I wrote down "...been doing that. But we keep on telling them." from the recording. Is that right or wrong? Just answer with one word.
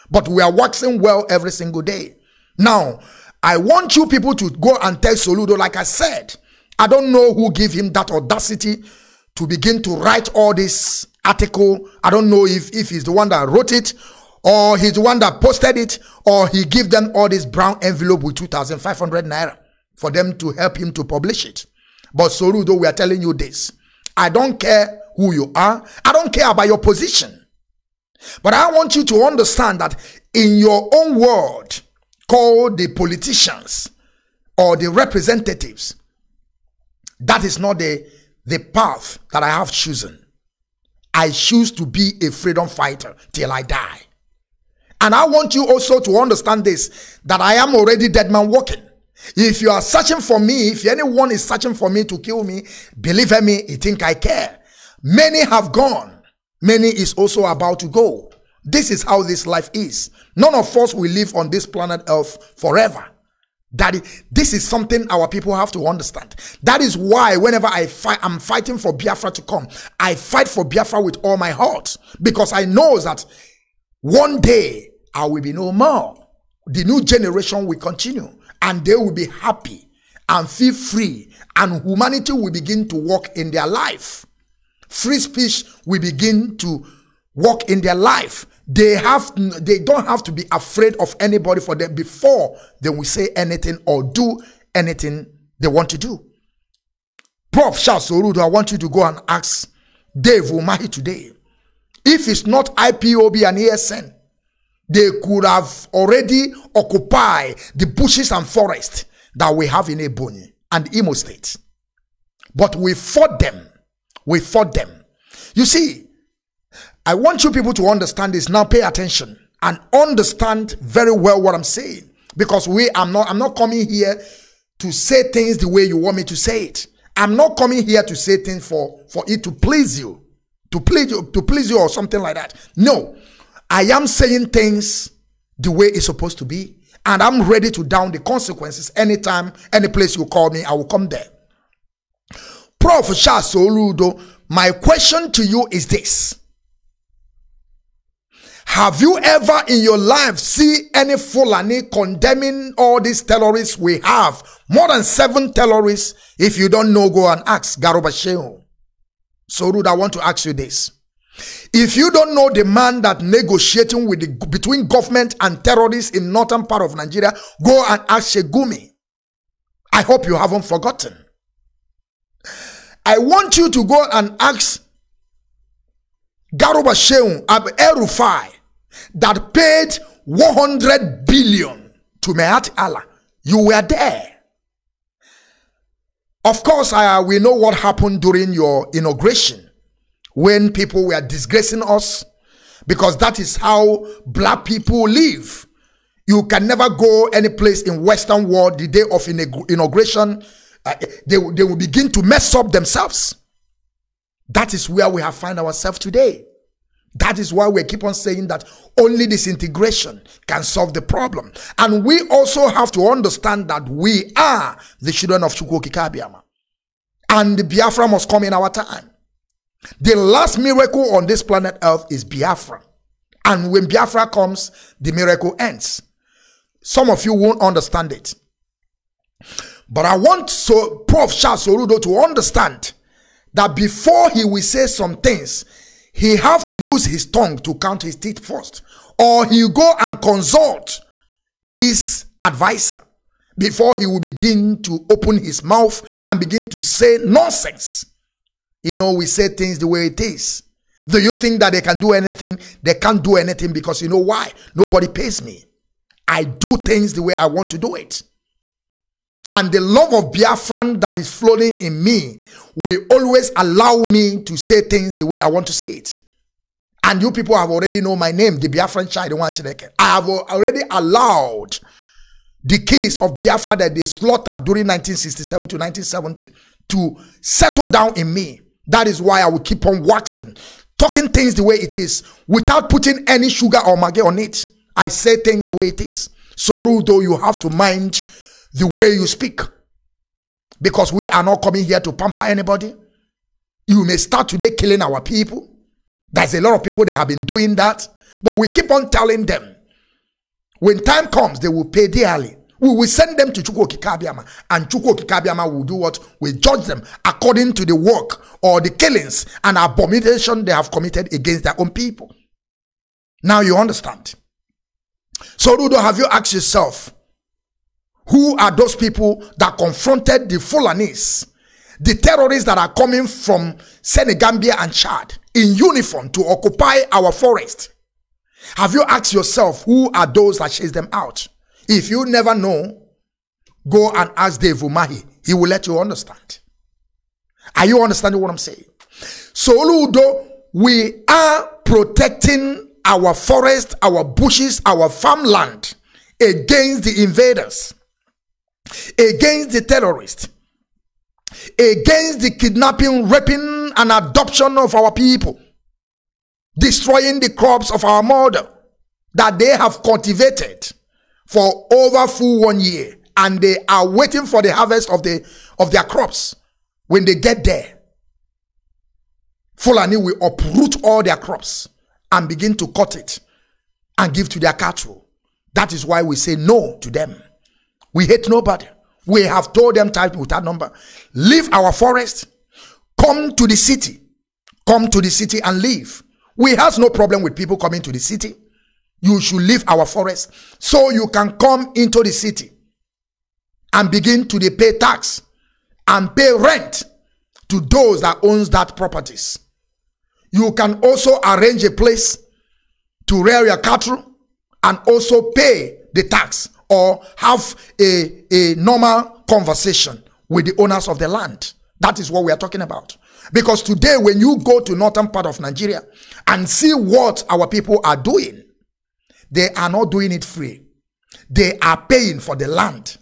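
right.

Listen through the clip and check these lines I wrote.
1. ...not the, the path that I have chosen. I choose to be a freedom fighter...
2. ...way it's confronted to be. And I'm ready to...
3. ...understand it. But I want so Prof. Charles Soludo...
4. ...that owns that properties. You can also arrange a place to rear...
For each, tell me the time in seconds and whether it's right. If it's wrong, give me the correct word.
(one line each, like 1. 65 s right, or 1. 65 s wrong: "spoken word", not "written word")
1. 37 s right
2. 135 s wrong: "supposed", not "confronted"
3. 227 s right
4. 398 s right.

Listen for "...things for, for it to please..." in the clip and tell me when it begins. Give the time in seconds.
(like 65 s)
128 s.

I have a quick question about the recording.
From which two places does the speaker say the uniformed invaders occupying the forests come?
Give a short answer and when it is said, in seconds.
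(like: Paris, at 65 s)
Senegambia and Chad, at 324 s.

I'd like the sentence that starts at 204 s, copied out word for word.
That is where we have found ourselves today.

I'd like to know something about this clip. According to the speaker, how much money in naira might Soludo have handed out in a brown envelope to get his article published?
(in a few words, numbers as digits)
2,500 naira.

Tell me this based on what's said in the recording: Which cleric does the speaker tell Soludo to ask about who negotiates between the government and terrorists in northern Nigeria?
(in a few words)
Sheikh Gumi.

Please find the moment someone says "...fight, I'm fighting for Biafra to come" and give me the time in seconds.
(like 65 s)
67 s.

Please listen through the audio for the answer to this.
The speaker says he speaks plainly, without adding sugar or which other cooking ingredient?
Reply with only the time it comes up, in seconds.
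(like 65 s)
283 s.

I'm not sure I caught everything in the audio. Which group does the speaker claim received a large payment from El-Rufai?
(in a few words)
Miyetti Allah.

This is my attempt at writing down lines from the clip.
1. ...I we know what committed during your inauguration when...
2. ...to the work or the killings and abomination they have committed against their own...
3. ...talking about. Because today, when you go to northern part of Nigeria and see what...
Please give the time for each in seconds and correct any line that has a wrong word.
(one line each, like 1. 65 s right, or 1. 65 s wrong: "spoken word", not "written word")
1. 186 s wrong: "happened", not "committed"
2. 307 s right
3. 412 s right.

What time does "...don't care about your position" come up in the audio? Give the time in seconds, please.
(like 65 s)
26 s.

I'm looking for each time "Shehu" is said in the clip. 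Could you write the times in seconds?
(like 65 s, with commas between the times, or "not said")
158 s, 176 s.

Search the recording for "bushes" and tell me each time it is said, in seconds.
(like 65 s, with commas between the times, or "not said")
107 s, 344 s.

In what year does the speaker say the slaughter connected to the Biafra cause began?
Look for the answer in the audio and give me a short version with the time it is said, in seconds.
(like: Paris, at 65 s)
1967, at 274 s.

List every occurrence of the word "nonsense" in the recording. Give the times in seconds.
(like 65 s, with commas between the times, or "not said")
247 s.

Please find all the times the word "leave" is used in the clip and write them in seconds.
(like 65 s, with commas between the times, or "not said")
381 s, 389 s.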